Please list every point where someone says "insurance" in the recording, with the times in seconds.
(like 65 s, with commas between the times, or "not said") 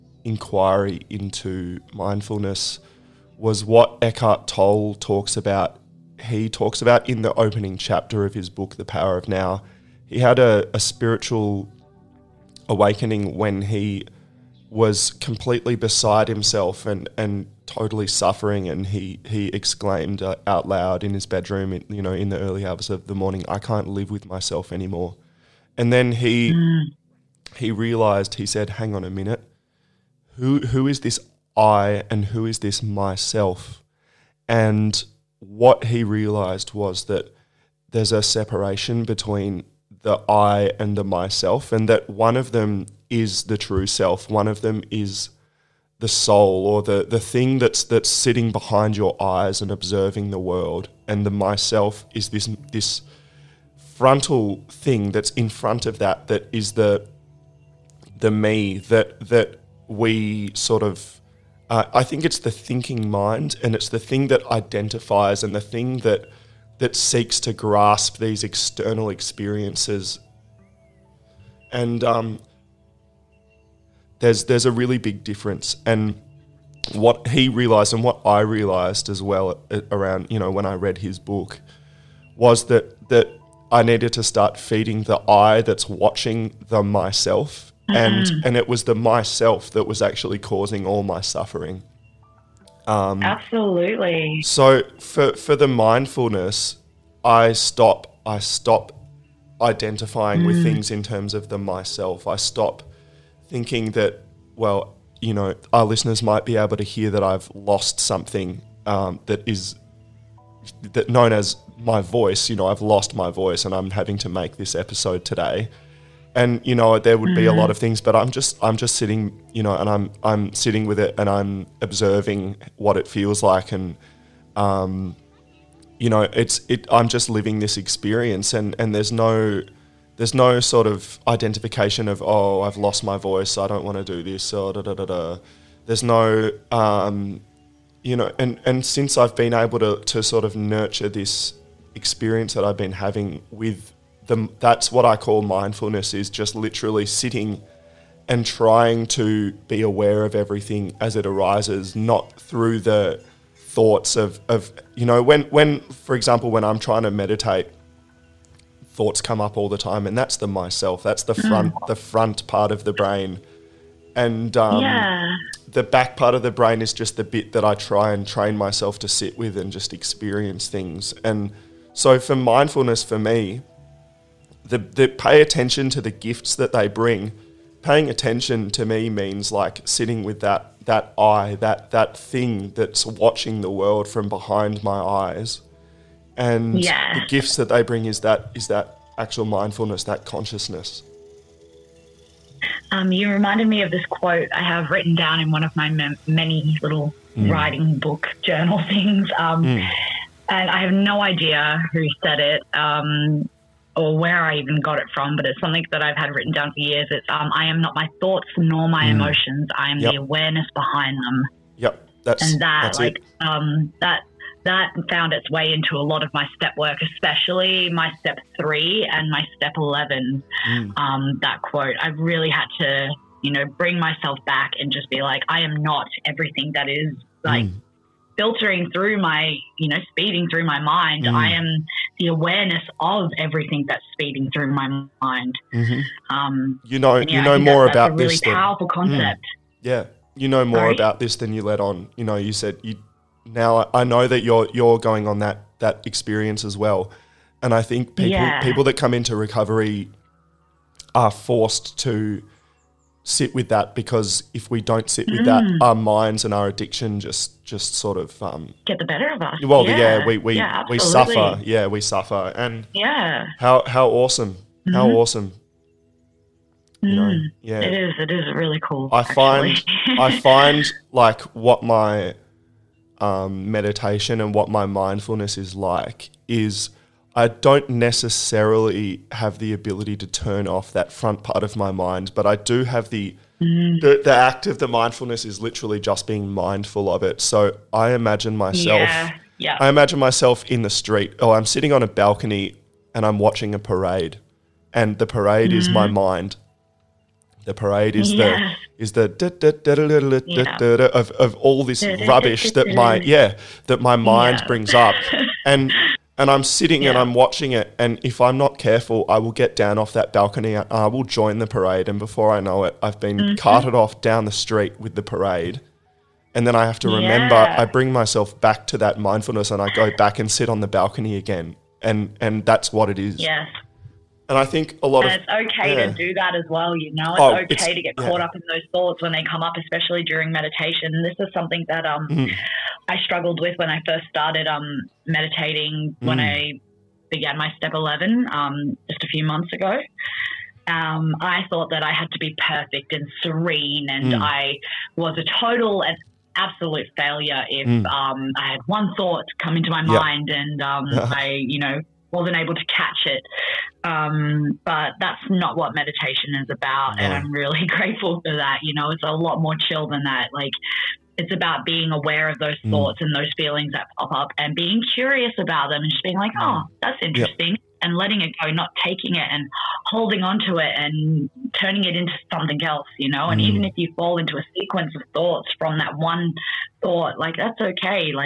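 not said.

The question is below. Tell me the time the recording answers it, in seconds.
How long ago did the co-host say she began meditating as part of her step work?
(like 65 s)
339 s.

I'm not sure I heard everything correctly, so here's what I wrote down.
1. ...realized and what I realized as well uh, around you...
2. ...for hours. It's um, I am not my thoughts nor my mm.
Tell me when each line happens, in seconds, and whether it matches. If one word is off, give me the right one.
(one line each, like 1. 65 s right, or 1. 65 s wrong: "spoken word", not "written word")
1. 77 s right
2. 206 s wrong: "years", not "hours".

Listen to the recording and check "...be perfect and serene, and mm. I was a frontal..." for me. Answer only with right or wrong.
wrong.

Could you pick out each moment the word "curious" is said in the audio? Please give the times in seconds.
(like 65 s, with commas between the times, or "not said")
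365 s.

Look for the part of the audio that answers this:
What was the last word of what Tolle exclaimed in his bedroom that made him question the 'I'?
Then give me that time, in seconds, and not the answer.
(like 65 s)
24 s.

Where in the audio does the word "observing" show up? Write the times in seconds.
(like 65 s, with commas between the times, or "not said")
49 s, 121 s.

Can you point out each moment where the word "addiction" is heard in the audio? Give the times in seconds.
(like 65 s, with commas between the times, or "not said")
256 s.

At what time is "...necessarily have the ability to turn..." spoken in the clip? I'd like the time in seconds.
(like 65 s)
277 s.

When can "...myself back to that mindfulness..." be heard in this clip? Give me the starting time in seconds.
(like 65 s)
318 s.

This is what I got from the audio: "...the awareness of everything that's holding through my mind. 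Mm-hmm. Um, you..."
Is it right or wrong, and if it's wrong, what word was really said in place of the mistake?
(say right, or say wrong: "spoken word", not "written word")
wrong: "speeding", not "holding".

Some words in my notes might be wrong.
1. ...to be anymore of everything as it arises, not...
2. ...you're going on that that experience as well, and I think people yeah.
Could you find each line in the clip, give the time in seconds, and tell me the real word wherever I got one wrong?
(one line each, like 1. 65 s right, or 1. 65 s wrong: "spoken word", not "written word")
1. 149 s wrong: "aware", not "anymore"
2. 244 s right.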